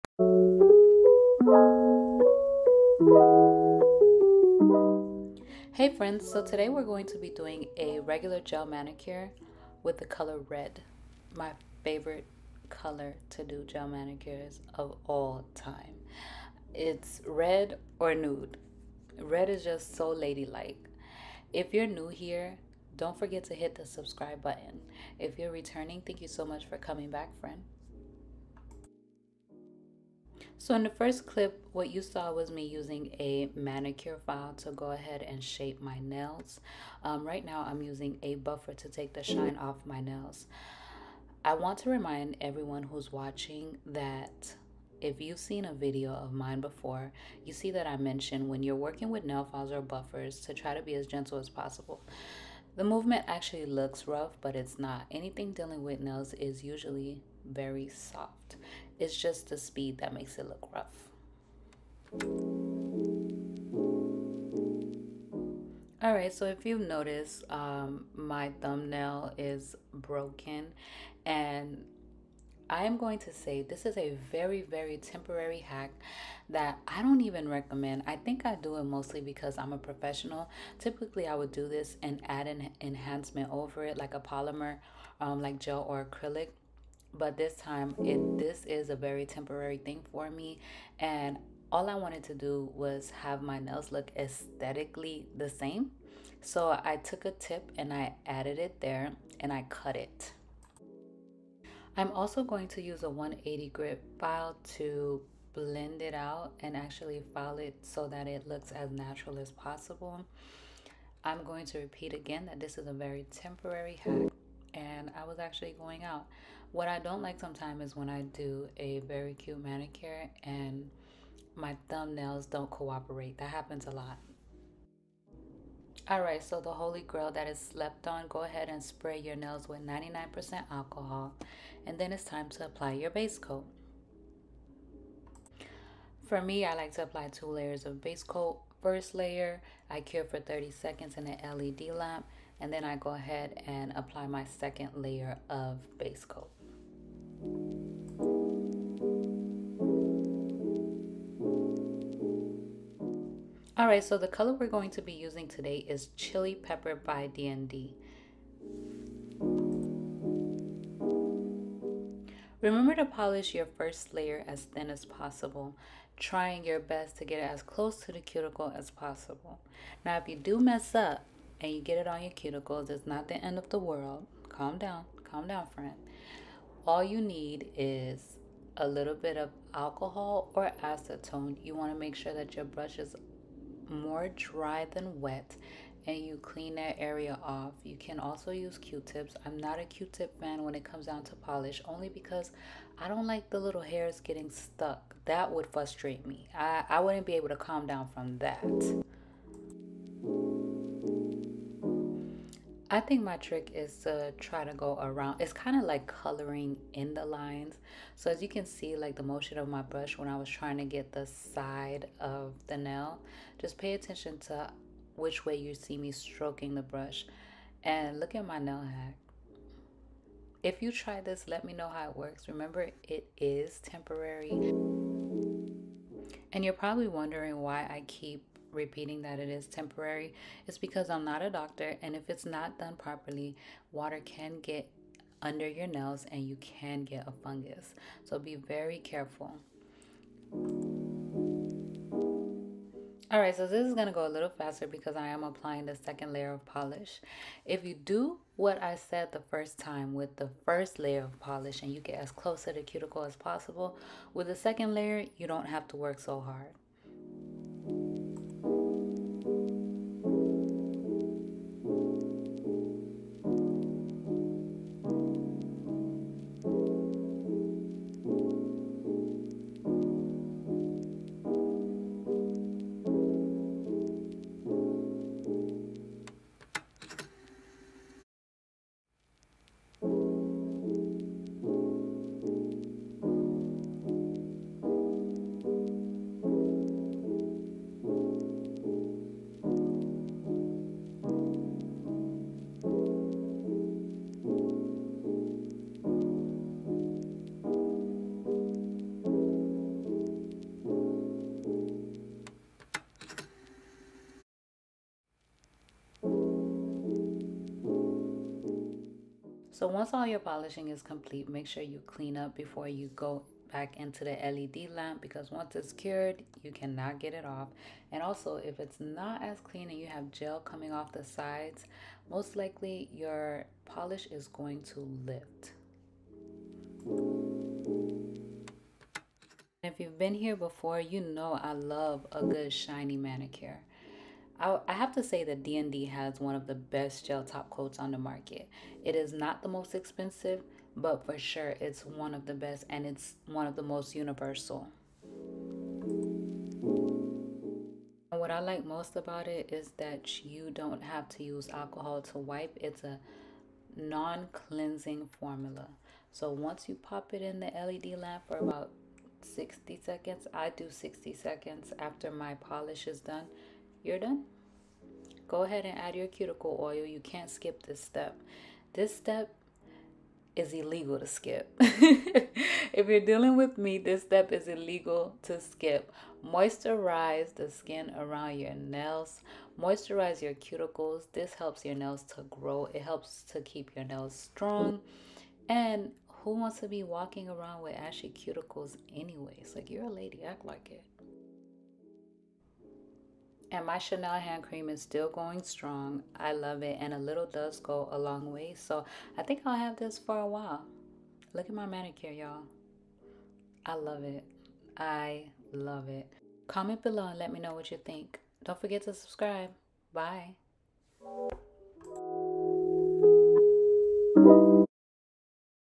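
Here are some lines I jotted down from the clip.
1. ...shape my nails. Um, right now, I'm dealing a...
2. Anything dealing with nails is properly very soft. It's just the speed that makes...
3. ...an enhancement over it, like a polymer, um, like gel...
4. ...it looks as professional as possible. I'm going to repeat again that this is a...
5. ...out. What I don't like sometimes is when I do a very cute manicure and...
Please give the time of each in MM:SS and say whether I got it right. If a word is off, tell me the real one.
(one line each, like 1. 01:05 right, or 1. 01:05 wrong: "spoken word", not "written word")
1. 00:35 wrong: "using", not "dealing"
2. 00:55 wrong: "usually", not "properly"
3. 01:22 right
4. 01:48 wrong: "natural", not "professional"
5. 01:56 right.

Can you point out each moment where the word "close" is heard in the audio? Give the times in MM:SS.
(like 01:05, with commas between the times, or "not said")
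02:47, 04:12.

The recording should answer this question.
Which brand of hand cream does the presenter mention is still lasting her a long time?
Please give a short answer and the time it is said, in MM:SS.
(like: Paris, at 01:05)
Chanel, at 06:33.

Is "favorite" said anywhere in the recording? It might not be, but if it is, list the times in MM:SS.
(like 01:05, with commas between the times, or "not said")
00:11.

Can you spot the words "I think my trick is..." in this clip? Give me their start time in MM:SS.
03:22.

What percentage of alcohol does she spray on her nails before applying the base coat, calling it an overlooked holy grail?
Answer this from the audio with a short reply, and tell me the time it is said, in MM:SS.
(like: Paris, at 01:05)
99%, at 02:09.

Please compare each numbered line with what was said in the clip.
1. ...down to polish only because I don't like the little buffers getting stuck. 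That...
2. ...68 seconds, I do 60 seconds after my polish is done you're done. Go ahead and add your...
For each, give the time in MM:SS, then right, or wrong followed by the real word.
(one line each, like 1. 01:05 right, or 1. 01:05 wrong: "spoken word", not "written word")
1. 03:11 wrong: "hairs", not "buffers"
2. 05:59 wrong: "60", not "68".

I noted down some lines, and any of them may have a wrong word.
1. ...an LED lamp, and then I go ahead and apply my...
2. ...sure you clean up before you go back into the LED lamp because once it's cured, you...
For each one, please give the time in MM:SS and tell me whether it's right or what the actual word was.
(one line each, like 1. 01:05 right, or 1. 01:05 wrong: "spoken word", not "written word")
1. 02:21 right
2. 05:11 right.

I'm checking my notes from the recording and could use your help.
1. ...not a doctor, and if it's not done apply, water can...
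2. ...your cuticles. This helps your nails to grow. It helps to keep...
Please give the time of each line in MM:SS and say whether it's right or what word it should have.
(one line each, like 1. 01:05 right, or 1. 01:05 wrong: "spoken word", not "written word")
1. 03:51 wrong: "properly", not "apply"
2. 06:20 right.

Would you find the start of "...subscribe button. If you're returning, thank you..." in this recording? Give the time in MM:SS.
00:23.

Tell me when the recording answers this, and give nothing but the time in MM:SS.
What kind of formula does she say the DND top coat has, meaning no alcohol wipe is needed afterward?
05:53.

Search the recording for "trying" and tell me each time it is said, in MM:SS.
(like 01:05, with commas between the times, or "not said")
02:46, 03:30.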